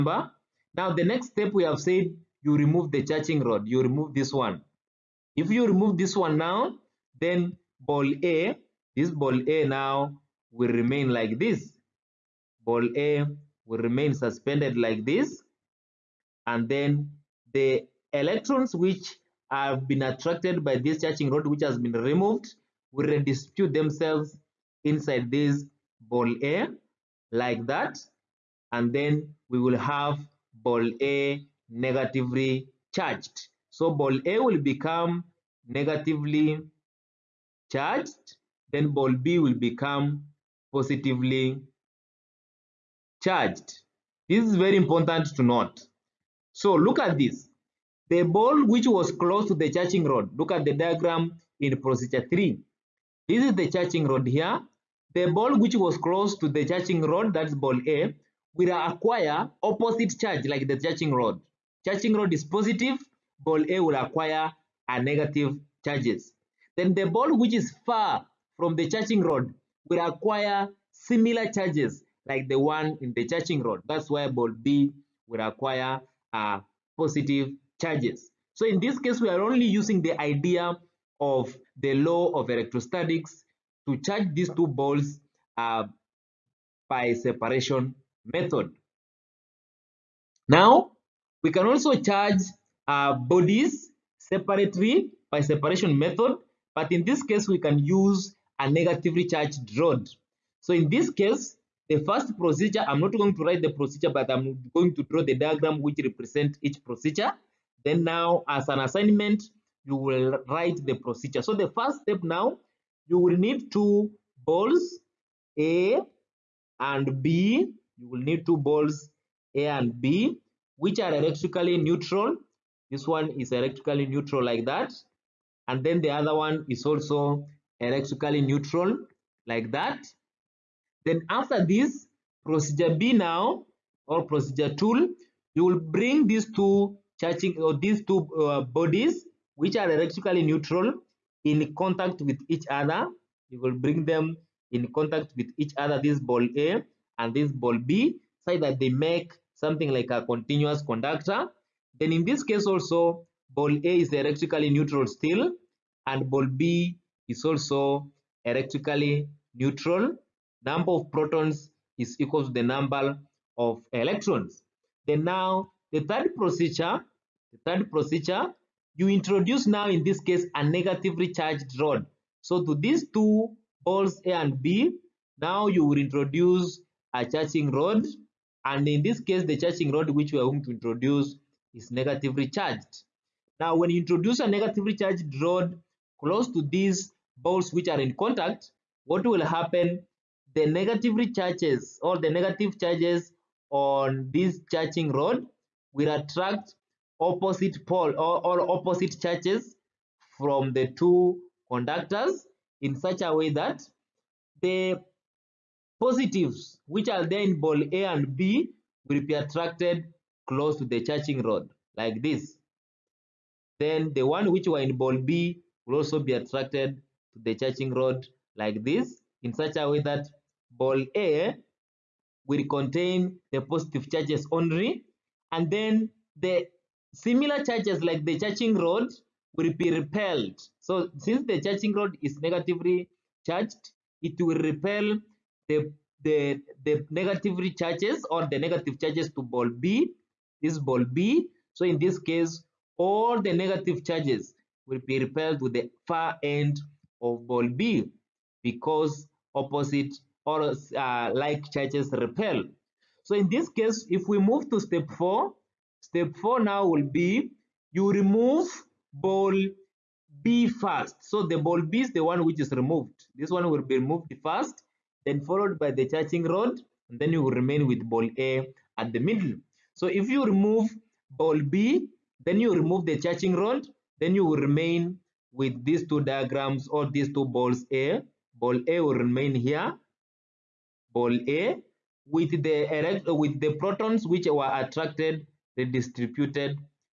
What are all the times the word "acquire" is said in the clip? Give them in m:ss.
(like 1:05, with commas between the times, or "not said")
0:58, 1:03, 1:10, 1:15.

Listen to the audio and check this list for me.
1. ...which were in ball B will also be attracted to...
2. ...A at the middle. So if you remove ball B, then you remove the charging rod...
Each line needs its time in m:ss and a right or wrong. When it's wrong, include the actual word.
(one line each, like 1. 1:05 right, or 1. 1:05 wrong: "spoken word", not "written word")
1. 3:34 right
2. 4:28 right.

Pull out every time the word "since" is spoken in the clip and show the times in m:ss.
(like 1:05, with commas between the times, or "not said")
3:51.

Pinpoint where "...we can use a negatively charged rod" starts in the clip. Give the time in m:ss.
1:37.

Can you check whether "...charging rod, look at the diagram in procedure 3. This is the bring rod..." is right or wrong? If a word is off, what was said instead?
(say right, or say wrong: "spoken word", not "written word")
wrong: "charging", not "bring".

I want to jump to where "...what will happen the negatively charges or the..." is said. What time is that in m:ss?
3:09.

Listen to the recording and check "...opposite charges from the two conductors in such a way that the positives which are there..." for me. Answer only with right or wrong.
right.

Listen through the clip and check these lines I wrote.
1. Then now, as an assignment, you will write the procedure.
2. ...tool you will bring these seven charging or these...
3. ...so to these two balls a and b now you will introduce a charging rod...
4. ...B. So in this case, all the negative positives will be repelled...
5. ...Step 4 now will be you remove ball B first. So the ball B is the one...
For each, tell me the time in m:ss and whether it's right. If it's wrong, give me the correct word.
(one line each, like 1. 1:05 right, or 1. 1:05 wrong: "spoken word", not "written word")
1. 1:47 right
2. 2:14 wrong: "two", not "seven"
3. 2:52 right
4. 4:01 wrong: "charges", not "positives"
5. 4:16 right.